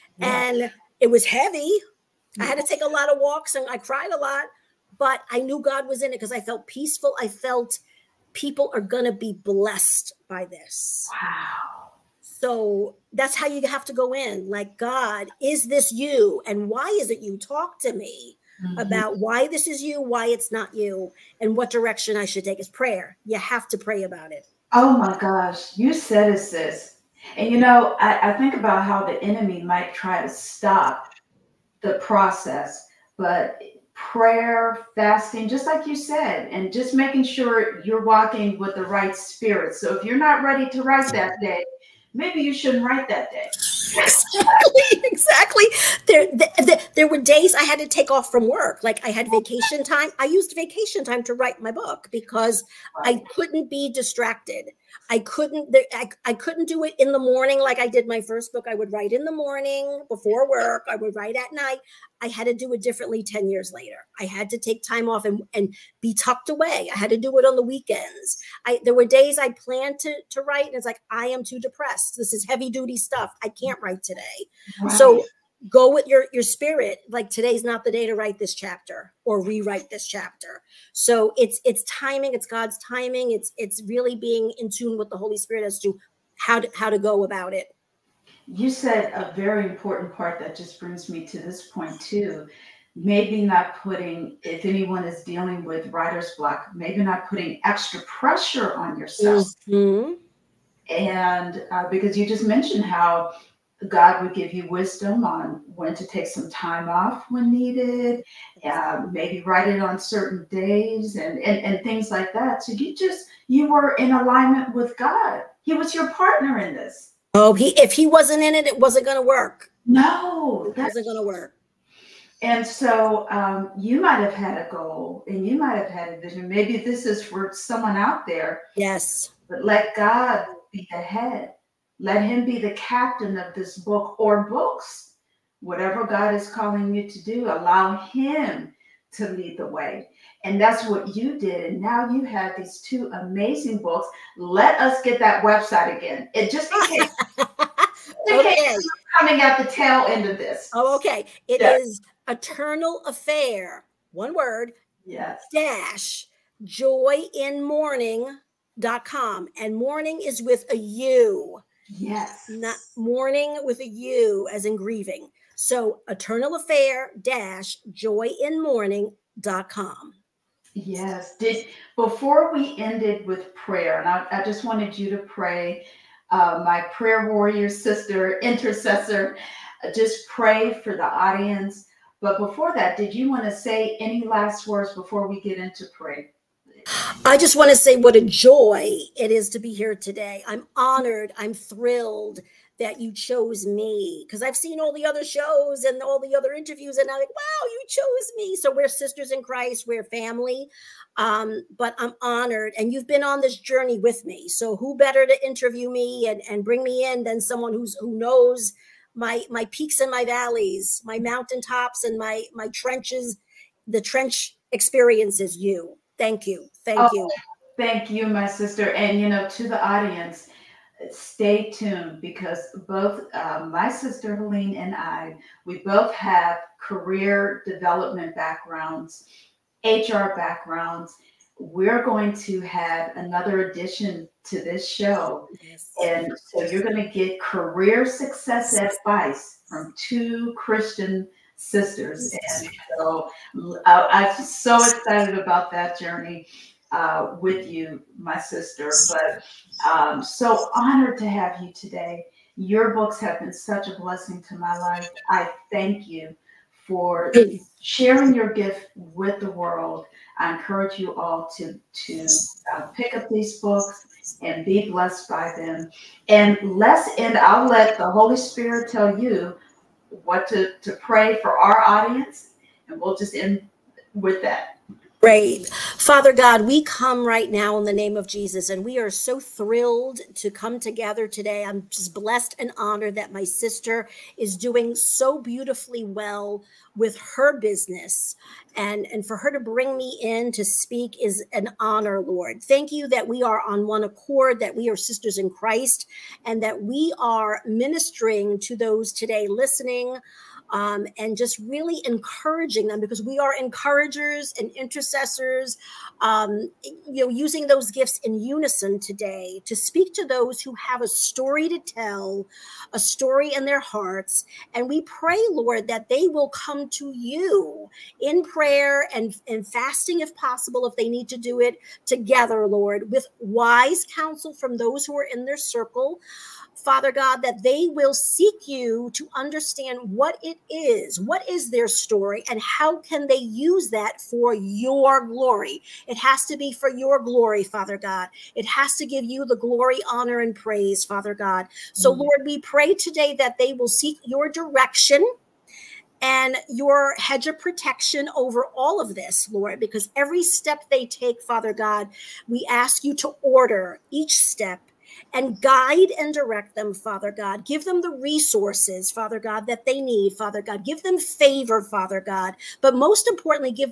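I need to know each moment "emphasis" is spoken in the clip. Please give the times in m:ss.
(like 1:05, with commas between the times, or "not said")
not said.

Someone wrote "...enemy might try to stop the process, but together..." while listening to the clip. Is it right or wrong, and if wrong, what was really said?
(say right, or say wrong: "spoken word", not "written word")
wrong: "prayer", not "together".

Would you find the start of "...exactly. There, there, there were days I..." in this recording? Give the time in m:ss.
0:45.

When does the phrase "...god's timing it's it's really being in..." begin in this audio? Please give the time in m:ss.
1:22.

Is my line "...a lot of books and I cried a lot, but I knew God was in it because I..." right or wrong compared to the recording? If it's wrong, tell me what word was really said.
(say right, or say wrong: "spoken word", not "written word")
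wrong: "walks", not "books".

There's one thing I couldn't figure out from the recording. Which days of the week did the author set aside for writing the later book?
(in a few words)
Weekends.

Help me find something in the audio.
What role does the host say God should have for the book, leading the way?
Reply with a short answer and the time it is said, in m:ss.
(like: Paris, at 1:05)
Captain, at 2:12.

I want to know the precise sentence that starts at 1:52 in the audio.
So you just, you were in alignment with God.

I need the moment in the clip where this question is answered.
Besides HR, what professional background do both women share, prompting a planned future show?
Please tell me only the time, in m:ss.
3:46.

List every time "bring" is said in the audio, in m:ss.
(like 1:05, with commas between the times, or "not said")
1:30, 3:26, 4:49.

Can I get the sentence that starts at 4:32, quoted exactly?
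And we'll just end with that.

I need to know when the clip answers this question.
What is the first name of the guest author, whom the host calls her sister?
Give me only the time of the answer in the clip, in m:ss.
3:44.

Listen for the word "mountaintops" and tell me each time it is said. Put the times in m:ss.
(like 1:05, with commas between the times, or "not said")
3:31.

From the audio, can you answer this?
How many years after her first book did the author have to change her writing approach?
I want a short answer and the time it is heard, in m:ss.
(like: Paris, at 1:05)
10 years, at 1:03.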